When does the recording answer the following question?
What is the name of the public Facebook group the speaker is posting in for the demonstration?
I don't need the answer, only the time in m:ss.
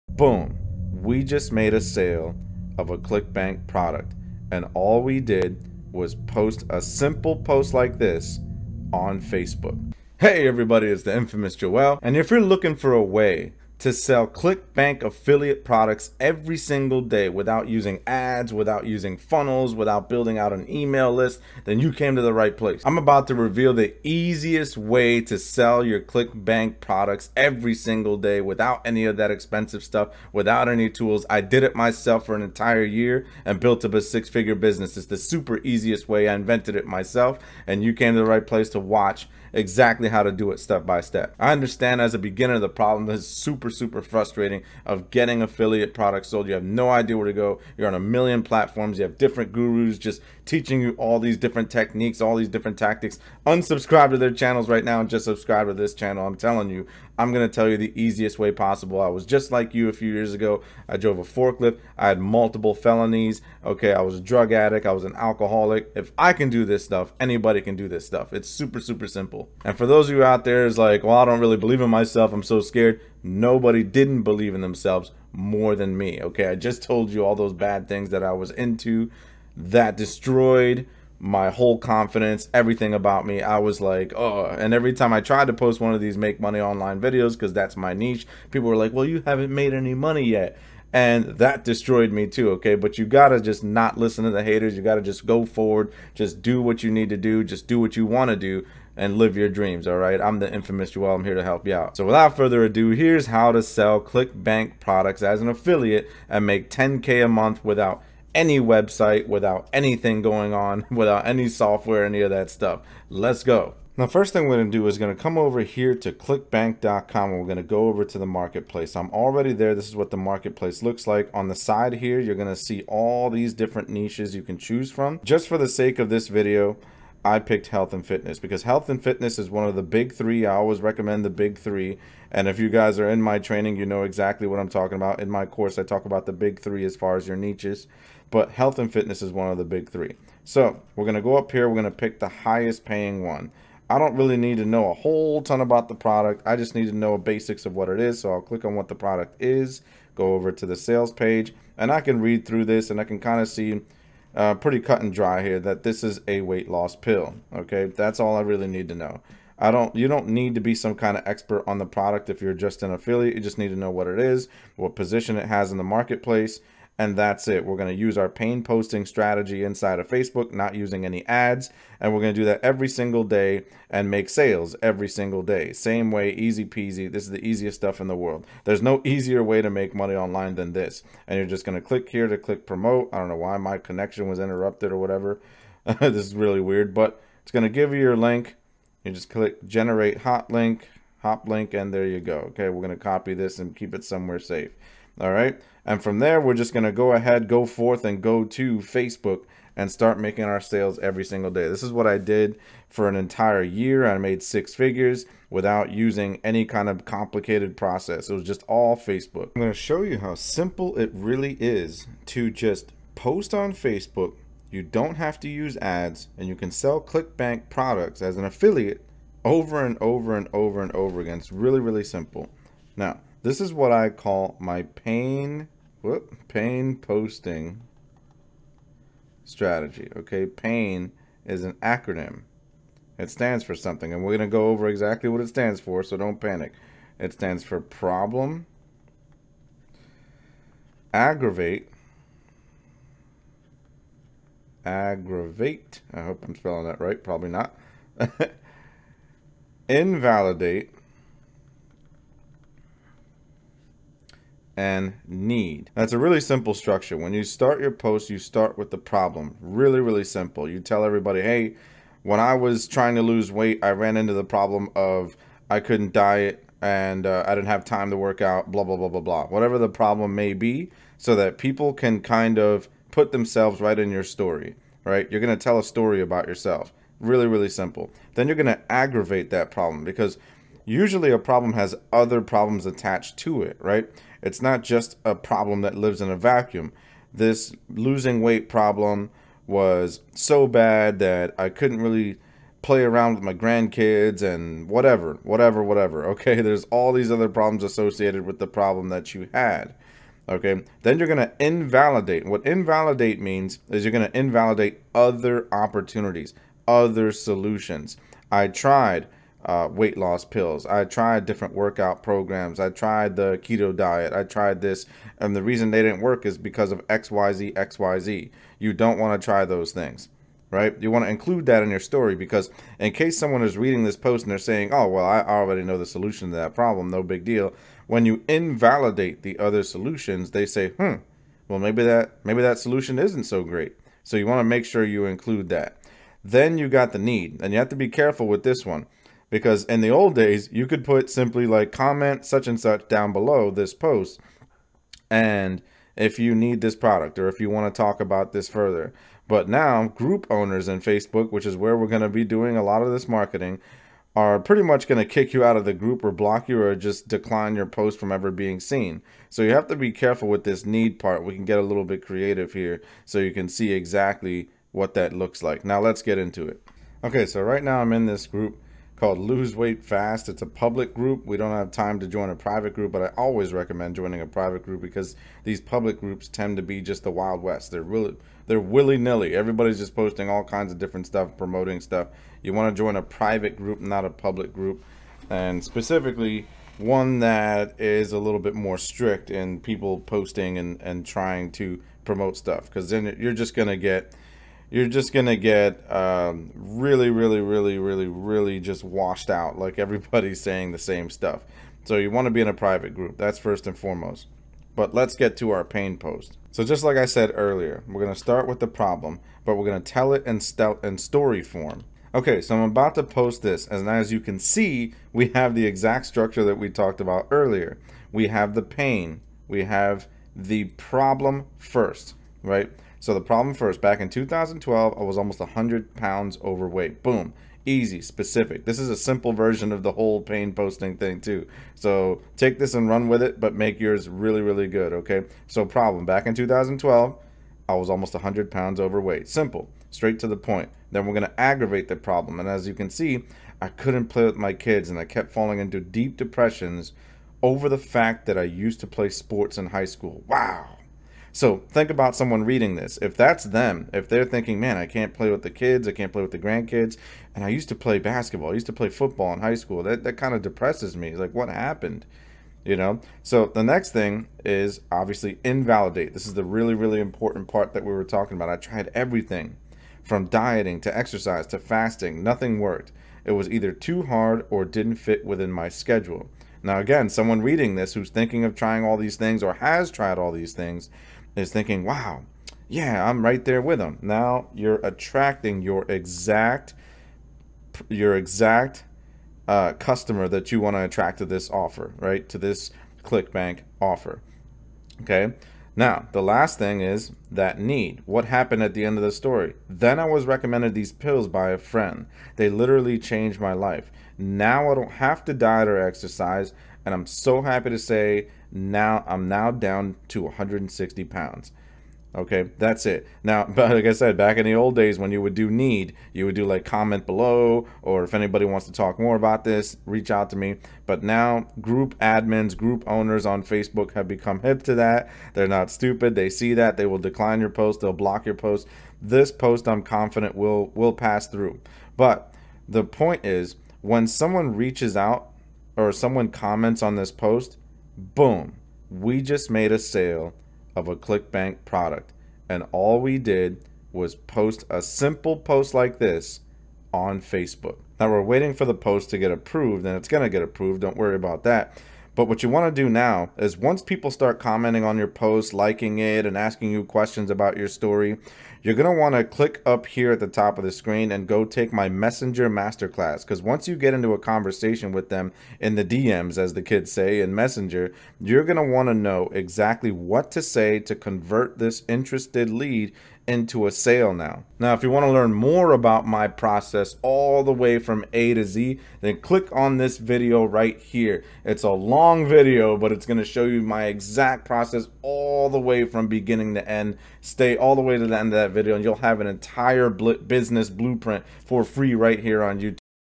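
6:09.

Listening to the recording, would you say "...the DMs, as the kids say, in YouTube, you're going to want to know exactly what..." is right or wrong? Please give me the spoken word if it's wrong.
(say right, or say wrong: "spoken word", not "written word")
wrong: "Messenger", not "YouTube".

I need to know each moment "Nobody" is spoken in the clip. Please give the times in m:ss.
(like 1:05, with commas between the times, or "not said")
1:13.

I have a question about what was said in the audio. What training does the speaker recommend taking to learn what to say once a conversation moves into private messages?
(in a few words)
Messenger Masterclass.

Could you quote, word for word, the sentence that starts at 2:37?
Okay, that's all I really need to know.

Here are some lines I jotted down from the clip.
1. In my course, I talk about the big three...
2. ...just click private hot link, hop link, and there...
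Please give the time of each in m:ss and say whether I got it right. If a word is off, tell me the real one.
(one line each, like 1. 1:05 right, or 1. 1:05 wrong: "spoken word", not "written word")
1. 2:15 right
2. 3:09 wrong: "generate", not "private".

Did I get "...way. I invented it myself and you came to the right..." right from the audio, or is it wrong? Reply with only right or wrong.
right.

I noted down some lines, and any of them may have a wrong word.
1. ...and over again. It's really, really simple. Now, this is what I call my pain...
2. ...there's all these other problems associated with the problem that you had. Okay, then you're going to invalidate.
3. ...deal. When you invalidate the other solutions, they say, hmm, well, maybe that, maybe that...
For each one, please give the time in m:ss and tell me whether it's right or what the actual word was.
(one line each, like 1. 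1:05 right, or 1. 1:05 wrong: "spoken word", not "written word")
1. 3:40 right
2. 4:56 right
3. 5:27 right.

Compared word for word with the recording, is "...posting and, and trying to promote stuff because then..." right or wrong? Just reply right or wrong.
right.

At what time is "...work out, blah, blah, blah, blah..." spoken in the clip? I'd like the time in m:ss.
4:28.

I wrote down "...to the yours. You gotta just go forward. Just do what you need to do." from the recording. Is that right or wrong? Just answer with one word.
wrong.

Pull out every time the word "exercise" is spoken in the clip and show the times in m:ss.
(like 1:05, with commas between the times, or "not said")
7:51, 8:25.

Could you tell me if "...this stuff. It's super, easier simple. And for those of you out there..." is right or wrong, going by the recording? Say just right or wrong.
wrong.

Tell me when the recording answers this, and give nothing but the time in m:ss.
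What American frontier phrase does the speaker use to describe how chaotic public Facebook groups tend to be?
6:17.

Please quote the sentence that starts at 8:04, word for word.
Now you're attracting your exact, your exact uh, customer that you want to attract to this offer, right?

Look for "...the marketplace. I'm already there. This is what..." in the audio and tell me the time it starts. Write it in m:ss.
1:58.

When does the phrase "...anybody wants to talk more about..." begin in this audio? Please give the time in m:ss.
8:38.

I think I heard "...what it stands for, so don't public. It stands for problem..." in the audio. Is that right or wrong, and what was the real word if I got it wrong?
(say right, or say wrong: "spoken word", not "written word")
wrong: "panic", not "public".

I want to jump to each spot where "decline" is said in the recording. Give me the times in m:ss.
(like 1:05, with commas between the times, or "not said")
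5:57, 8:47.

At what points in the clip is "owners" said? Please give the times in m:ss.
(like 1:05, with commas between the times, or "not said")
5:50, 8:43.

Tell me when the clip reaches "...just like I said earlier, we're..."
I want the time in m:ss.
6:46.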